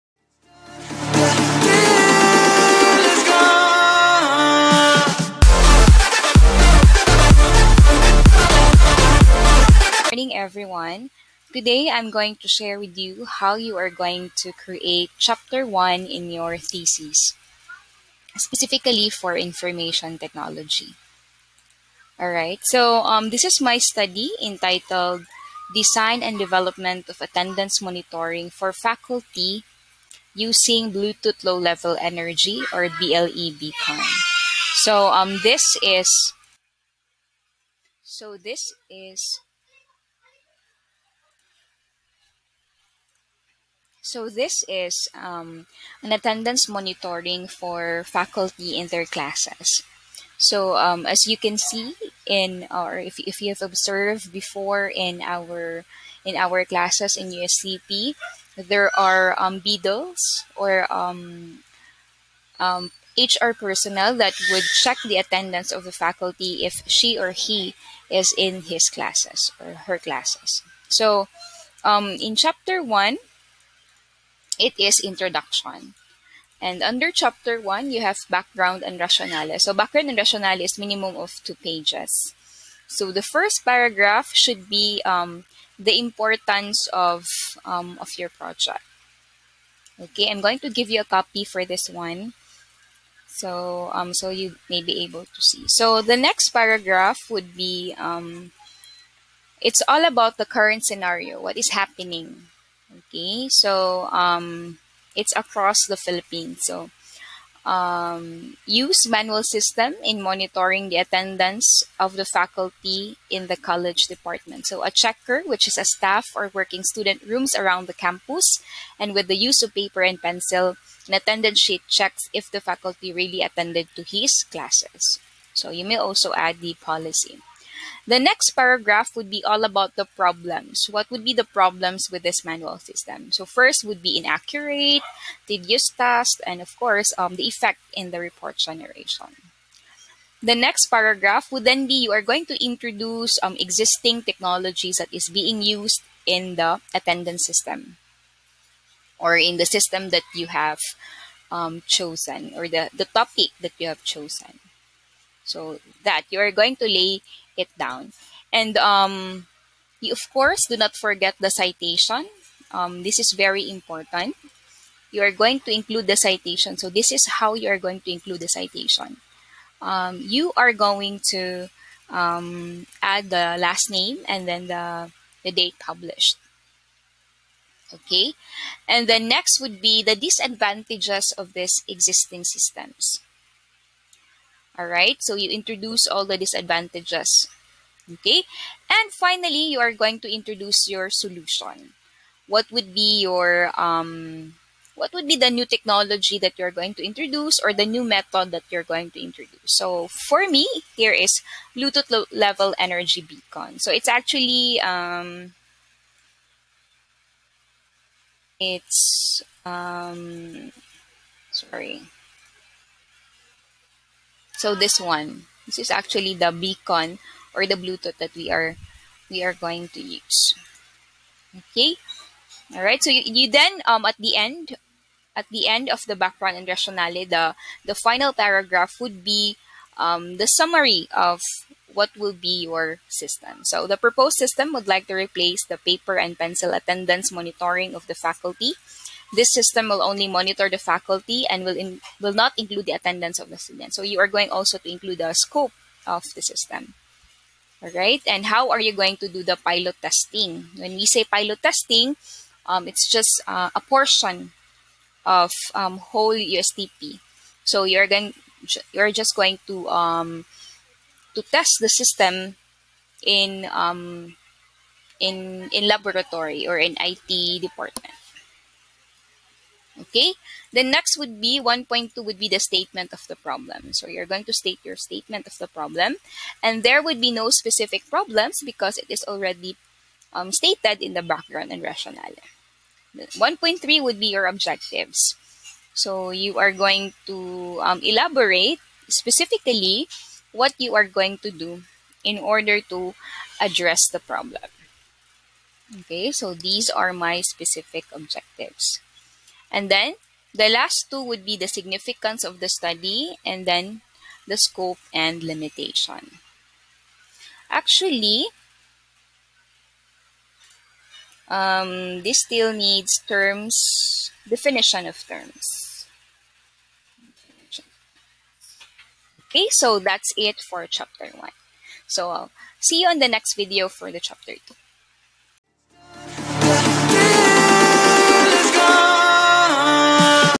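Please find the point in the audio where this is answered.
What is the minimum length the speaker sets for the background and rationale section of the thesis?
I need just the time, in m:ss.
1:20.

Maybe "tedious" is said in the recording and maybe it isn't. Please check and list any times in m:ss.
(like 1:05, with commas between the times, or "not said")
2:15.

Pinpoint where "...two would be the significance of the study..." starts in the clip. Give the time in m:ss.
5:01.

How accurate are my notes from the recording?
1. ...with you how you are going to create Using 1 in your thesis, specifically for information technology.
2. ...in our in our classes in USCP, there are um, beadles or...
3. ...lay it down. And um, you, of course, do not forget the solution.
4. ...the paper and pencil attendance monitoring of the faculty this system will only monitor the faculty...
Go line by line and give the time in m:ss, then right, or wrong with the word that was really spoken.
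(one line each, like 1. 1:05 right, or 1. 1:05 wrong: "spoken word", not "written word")
1. 0:12 wrong: "Chapter", not "Using"
2. 0:54 right
3. 2:36 wrong: "citation", not "solution"
4. 3:55 right.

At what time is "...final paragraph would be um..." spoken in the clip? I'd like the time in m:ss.
3:47.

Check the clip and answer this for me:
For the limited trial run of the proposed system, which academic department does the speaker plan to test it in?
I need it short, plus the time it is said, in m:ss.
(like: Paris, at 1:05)
IT department, at 4:26.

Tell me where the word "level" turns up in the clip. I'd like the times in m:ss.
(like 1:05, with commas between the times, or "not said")
0:31, 3:22.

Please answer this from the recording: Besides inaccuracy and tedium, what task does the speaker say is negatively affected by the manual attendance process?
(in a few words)
report generation.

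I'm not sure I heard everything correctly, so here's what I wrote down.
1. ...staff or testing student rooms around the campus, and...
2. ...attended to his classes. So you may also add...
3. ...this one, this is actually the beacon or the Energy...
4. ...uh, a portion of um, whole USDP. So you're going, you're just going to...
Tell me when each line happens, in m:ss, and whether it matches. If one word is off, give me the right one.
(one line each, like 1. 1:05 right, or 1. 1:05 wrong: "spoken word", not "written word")
1. 1:55 wrong: "working", not "testing"
2. 2:03 right
3. 3:34 wrong: "Bluetooth", not "Energy"
4. 4:13 right.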